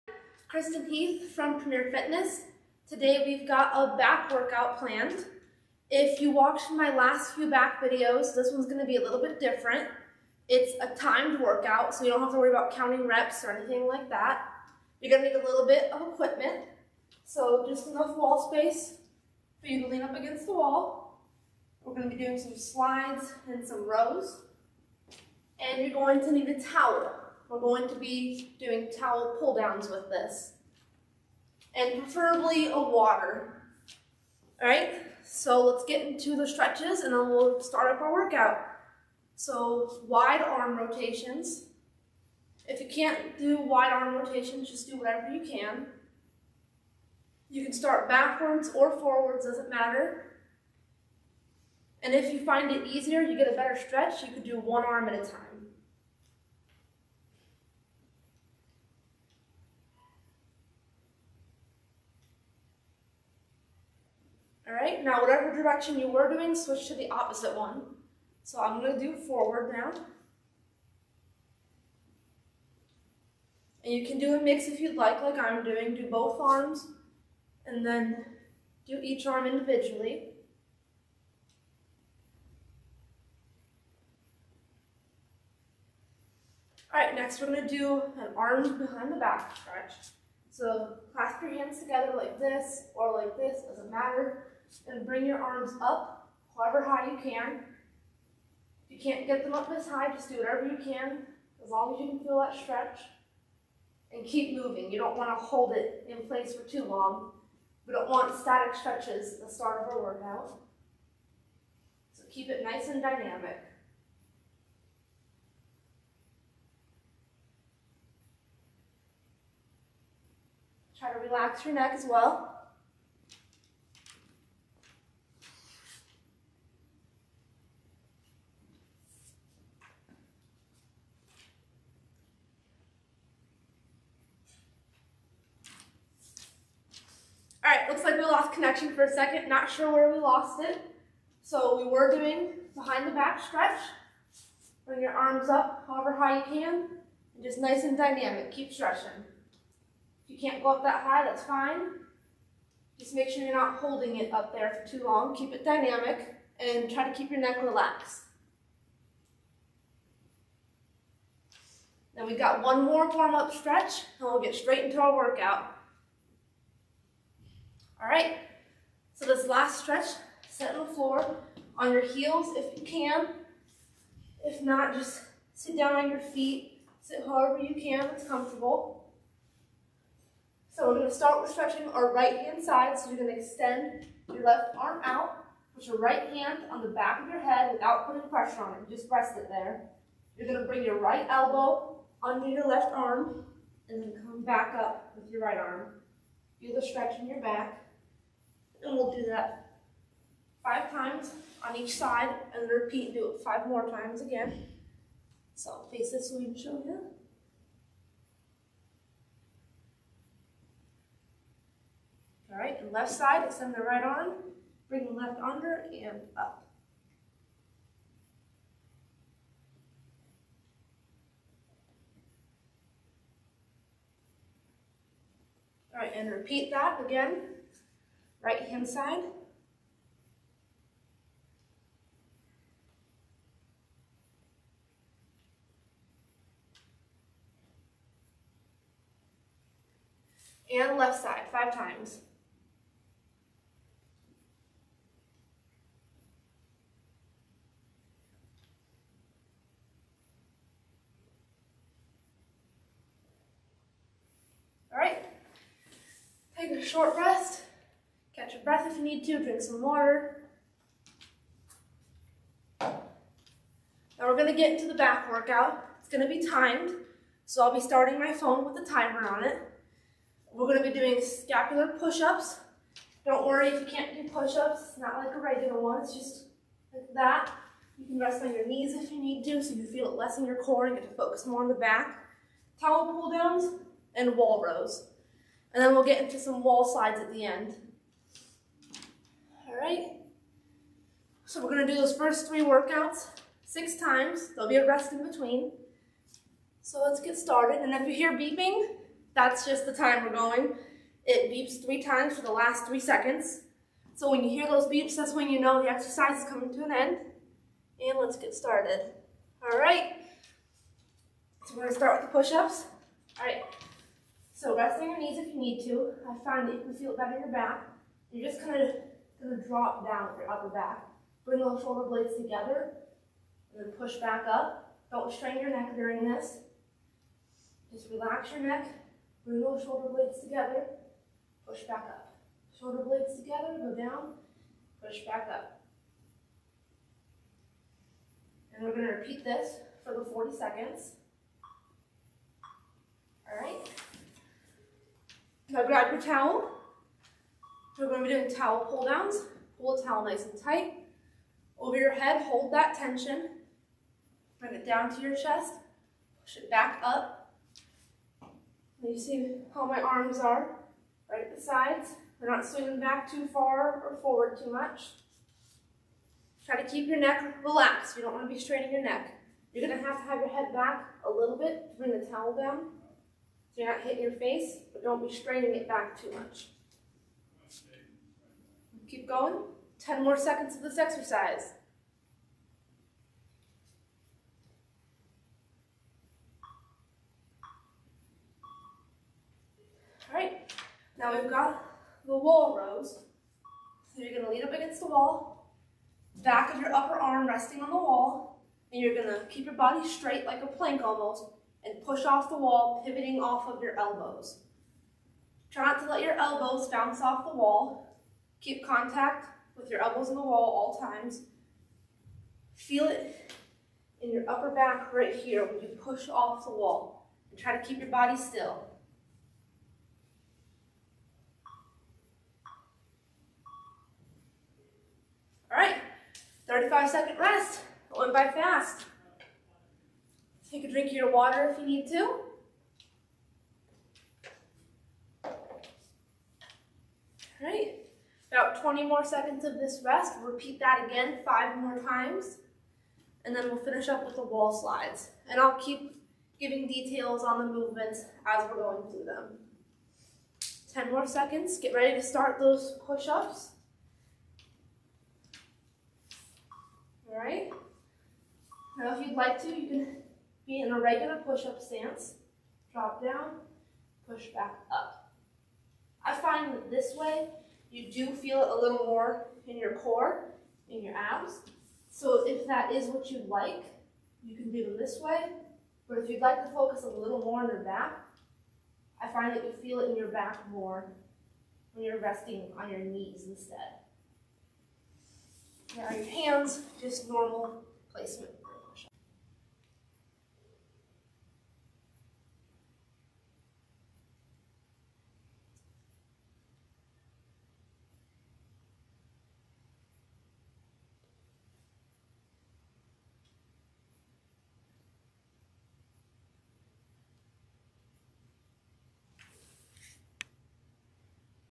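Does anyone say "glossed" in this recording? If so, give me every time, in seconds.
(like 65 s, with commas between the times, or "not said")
not said.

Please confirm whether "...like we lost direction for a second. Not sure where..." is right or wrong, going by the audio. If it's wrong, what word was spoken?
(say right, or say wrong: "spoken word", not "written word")
wrong: "connection", not "direction".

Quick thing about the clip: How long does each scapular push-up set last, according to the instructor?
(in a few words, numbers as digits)
40 seconds.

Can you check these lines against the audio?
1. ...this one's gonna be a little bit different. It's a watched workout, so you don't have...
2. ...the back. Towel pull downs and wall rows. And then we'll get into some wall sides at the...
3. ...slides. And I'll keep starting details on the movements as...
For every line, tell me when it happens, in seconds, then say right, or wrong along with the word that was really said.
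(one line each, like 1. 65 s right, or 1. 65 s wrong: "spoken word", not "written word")
1. 8 s wrong: "timed", not "watched"
2. 281 s wrong: "slides", not "sides"
3. 444 s wrong: "giving", not "starting".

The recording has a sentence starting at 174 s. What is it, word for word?
If not, just sit down on your feet, sit however you can, it's comfortable.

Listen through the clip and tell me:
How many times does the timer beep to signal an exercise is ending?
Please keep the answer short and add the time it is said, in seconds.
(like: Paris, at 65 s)
3, at 301 s.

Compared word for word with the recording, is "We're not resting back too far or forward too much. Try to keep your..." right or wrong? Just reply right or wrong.
wrong.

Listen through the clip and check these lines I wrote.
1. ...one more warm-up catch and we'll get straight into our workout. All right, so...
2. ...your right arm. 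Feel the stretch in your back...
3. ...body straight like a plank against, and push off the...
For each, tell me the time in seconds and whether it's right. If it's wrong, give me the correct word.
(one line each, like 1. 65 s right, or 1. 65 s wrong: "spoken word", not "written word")
1. 162 s wrong: "stretch", not "catch"
2. 195 s right
3. 399 s wrong: "almost", not "against".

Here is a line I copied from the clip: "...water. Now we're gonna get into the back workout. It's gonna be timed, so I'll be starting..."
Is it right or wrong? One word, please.
right.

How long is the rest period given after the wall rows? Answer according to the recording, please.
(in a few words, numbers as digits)
35 seconds.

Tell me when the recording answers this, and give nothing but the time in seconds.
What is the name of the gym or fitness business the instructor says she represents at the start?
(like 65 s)
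1 s.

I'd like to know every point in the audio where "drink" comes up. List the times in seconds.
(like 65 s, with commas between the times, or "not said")
259 s, 430 s.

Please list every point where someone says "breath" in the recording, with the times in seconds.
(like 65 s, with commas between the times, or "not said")
258 s.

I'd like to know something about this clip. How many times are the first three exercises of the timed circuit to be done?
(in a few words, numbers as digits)
6.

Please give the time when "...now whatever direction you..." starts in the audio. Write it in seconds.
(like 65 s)
65 s.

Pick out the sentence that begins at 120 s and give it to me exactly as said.
Try to relax your neck as well.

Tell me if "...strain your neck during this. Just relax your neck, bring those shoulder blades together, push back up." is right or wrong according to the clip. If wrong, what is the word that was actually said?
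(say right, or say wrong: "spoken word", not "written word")
right.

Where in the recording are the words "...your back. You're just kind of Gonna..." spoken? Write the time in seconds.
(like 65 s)
317 s.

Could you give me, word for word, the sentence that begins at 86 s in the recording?
All right, next we're gonna do an arm behind the back stretch.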